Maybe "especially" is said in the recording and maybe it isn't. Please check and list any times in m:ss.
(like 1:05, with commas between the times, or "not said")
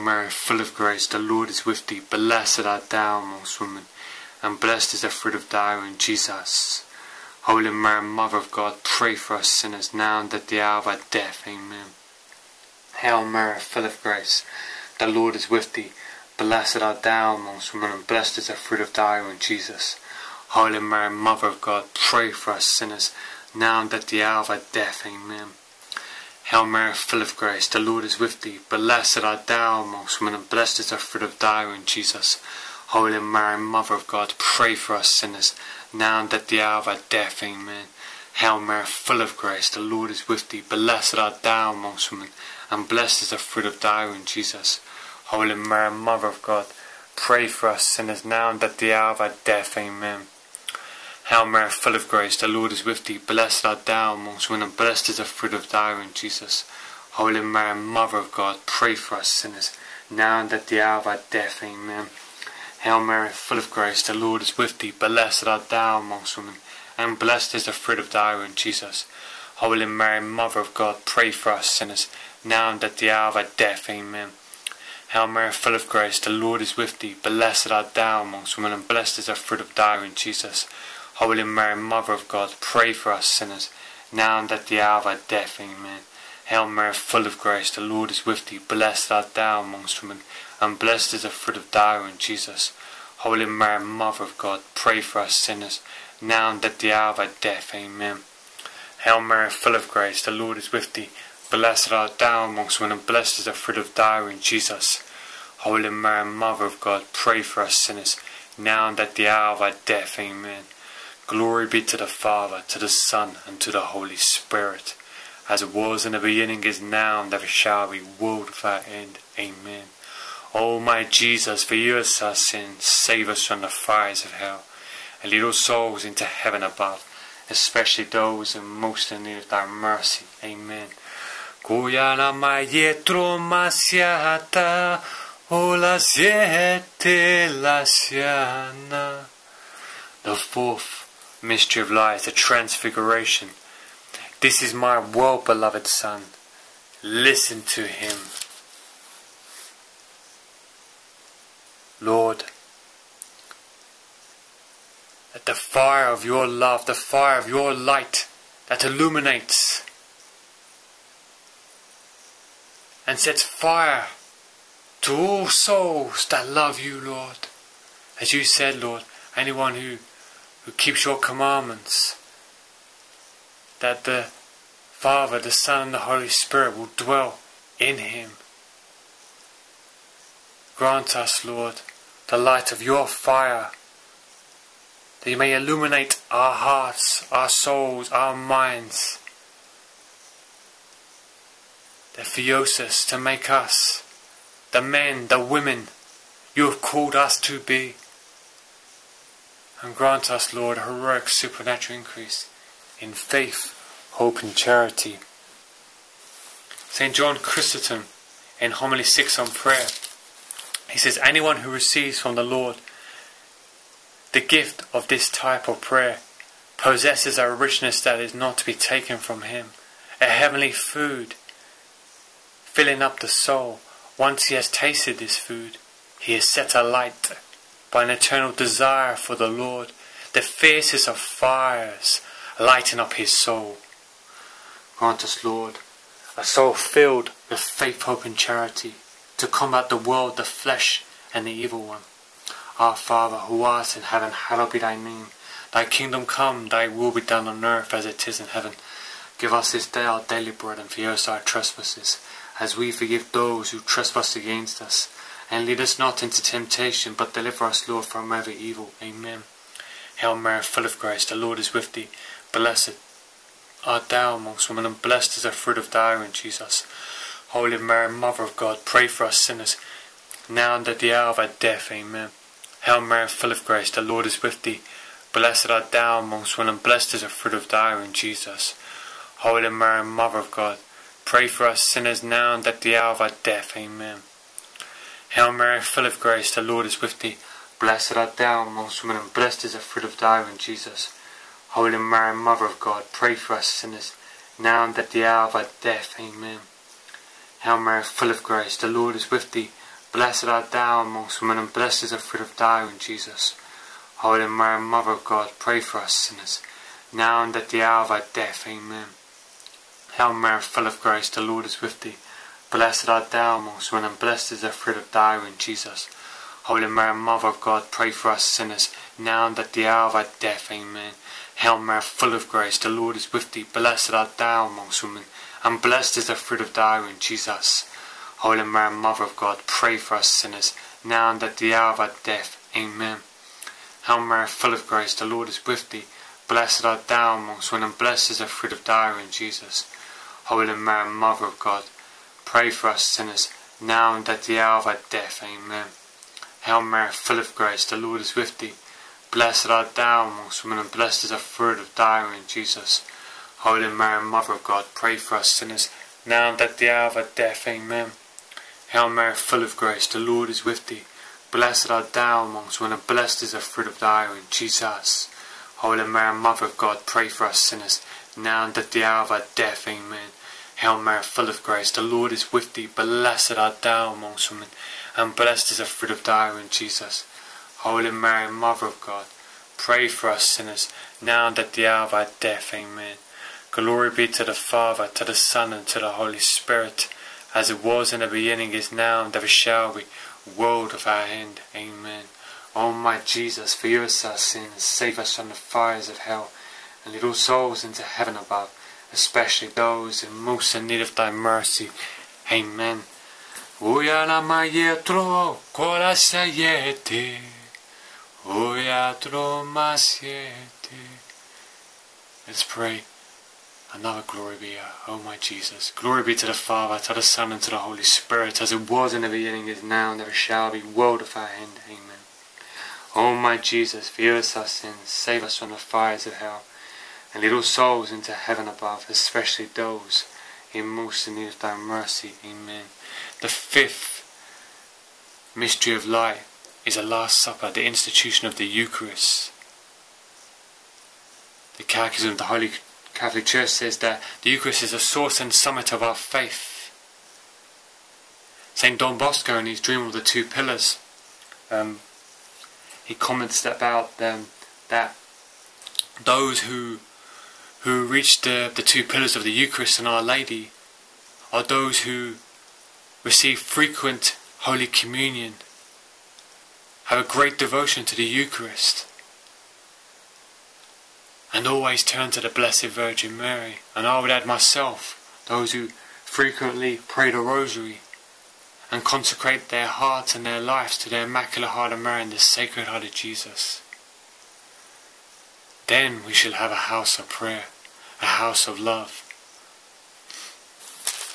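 2:07, 6:39, 7:09.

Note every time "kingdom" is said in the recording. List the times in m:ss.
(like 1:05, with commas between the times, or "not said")
4:05.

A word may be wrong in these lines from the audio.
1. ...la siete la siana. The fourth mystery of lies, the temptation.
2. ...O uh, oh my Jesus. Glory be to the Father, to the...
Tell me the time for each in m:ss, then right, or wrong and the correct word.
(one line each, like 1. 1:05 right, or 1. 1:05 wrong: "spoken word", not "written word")
1. 2:15 wrong: "transfiguration", not "temptation"
2. 6:54 right.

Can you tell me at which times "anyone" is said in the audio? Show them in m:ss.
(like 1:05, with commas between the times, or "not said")
2:49, 3:31.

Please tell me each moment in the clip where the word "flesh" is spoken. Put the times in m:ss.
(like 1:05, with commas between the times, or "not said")
4:00.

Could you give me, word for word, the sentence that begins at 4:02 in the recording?
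Our Father, who art in heaven, hallowed be thy name.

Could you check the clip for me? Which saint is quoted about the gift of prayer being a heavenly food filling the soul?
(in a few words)
St. John Chrysostom.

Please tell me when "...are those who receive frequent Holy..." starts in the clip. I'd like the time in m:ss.
7:41.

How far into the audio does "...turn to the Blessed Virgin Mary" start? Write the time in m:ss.
7:52.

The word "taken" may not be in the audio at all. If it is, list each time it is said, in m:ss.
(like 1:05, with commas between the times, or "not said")
3:38.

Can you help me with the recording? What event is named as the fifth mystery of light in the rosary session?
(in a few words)
The Last Supper.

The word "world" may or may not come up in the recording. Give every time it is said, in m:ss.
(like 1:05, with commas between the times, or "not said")
1:58, 3:59, 6:30, 7:00.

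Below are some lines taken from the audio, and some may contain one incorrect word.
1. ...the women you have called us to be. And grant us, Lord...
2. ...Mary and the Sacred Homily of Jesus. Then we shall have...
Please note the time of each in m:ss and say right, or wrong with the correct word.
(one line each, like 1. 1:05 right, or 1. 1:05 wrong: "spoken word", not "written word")
1. 3:15 right
2. 8:01 wrong: "Heart", not "Homily".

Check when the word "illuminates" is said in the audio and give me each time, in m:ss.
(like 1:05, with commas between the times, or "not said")
2:38, 3:05.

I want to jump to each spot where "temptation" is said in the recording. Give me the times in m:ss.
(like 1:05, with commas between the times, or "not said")
4:16.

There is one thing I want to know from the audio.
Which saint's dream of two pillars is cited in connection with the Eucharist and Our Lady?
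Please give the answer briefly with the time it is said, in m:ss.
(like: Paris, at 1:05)
St. Don Bosco, at 7:28.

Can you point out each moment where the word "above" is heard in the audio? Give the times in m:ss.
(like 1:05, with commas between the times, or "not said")
2:06, 6:38, 7:08.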